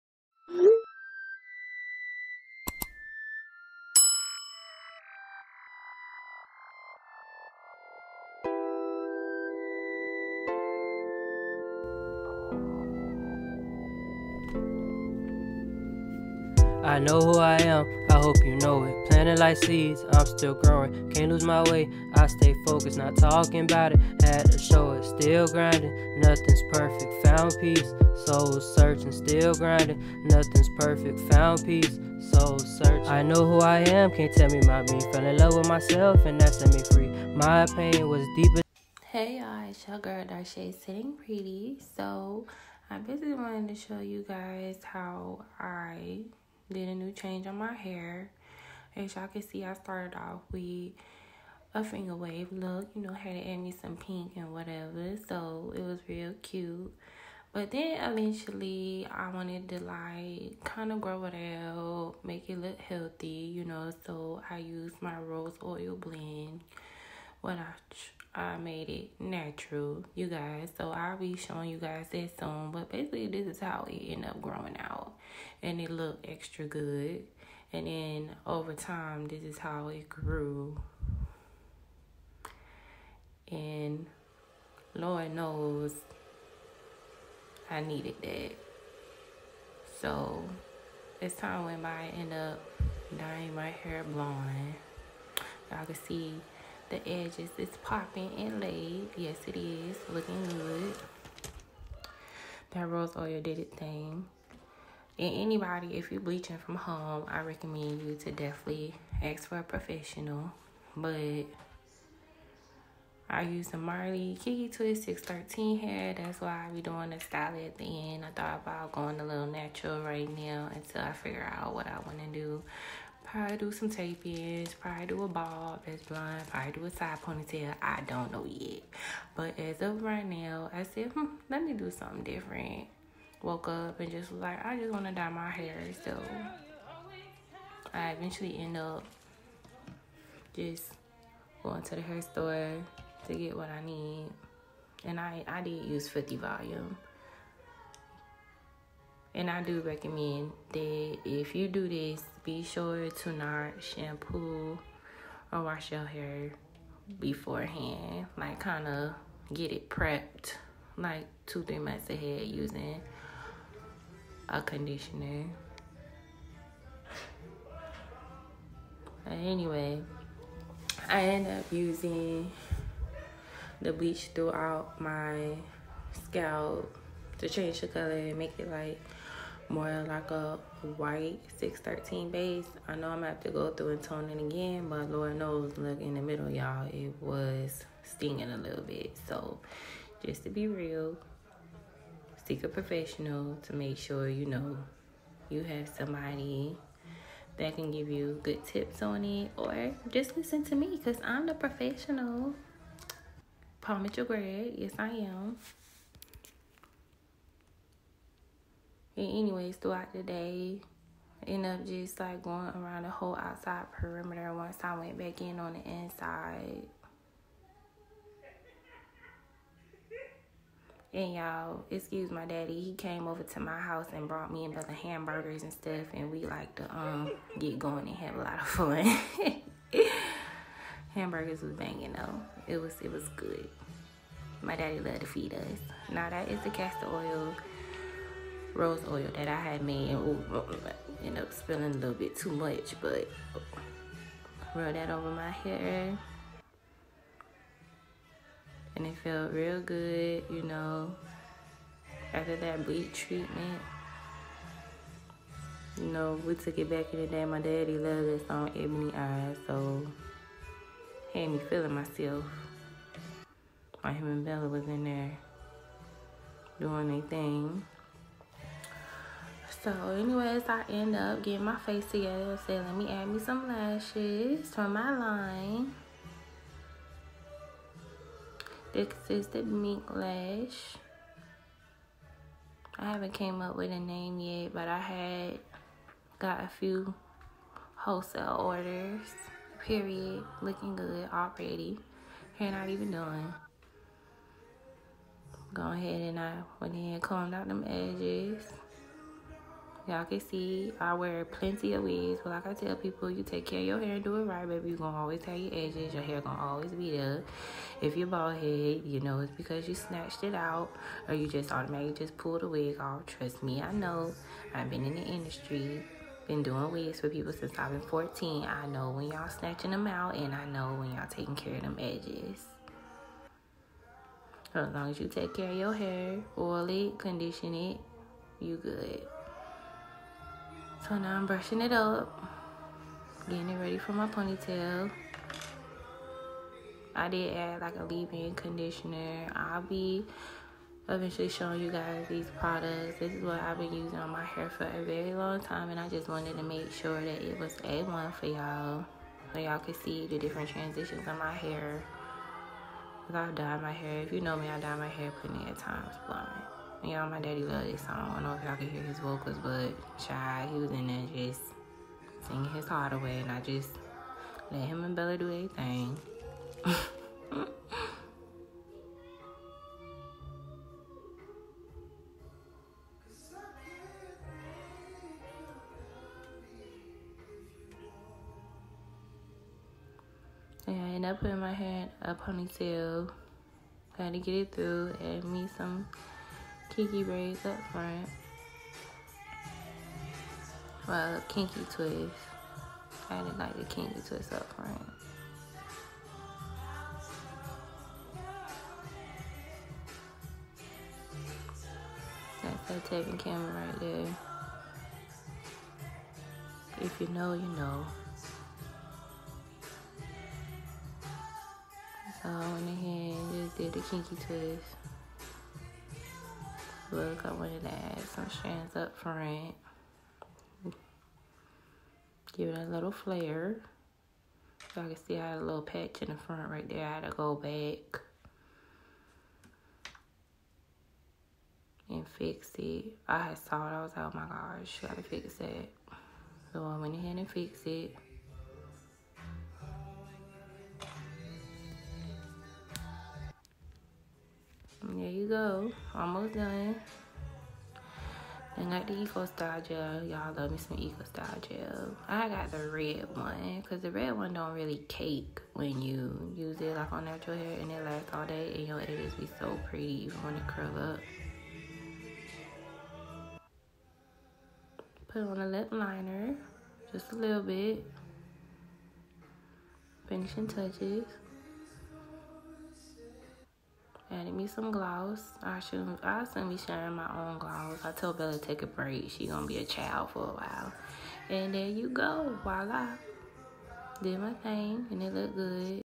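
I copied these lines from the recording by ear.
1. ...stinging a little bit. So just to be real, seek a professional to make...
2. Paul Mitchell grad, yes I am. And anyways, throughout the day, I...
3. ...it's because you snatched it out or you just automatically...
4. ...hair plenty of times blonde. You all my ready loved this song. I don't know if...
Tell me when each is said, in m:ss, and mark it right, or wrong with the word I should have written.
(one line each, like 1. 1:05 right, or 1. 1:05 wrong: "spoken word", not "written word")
1. 3:08 right
2. 3:23 right
3. 5:09 right
4. 5:55 wrong: "daddy", not "ready".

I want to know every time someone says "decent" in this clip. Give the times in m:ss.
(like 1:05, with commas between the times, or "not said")
not said.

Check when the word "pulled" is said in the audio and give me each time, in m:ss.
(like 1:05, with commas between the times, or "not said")
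5:12.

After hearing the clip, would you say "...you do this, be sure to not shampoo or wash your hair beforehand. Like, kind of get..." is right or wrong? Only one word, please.
right.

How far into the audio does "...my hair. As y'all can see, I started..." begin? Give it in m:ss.
0:47.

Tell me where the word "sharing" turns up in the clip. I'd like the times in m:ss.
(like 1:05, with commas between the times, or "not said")
7:56.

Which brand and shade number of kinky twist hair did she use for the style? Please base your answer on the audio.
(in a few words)
Marley Kinky Twist 613.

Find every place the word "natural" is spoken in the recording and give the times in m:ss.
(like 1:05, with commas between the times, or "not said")
1:09, 1:59, 7:37.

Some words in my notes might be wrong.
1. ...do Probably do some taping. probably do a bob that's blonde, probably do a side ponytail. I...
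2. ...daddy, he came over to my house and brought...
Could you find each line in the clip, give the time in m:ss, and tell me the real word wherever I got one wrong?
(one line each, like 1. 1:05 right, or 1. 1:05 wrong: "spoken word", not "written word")
1. 2:02 right
2. 3:42 right.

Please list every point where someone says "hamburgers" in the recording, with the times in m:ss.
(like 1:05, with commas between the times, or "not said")
3:44, 3:51.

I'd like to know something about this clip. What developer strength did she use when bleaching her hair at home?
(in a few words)
50 volume.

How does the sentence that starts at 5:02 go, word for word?
But like I tell people, you take care of your hair and do it right, baby.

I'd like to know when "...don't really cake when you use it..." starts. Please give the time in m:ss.
7:34.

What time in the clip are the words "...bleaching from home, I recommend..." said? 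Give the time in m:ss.
1:46.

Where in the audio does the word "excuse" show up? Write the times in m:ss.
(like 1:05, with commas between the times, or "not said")
3:41.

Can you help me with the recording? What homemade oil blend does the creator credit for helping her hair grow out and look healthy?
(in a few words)
rose oil blend.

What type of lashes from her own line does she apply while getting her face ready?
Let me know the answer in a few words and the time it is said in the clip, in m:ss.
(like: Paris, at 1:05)
Mink Lash, at 4:39.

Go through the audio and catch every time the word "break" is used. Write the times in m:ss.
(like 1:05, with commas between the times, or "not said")
7:58.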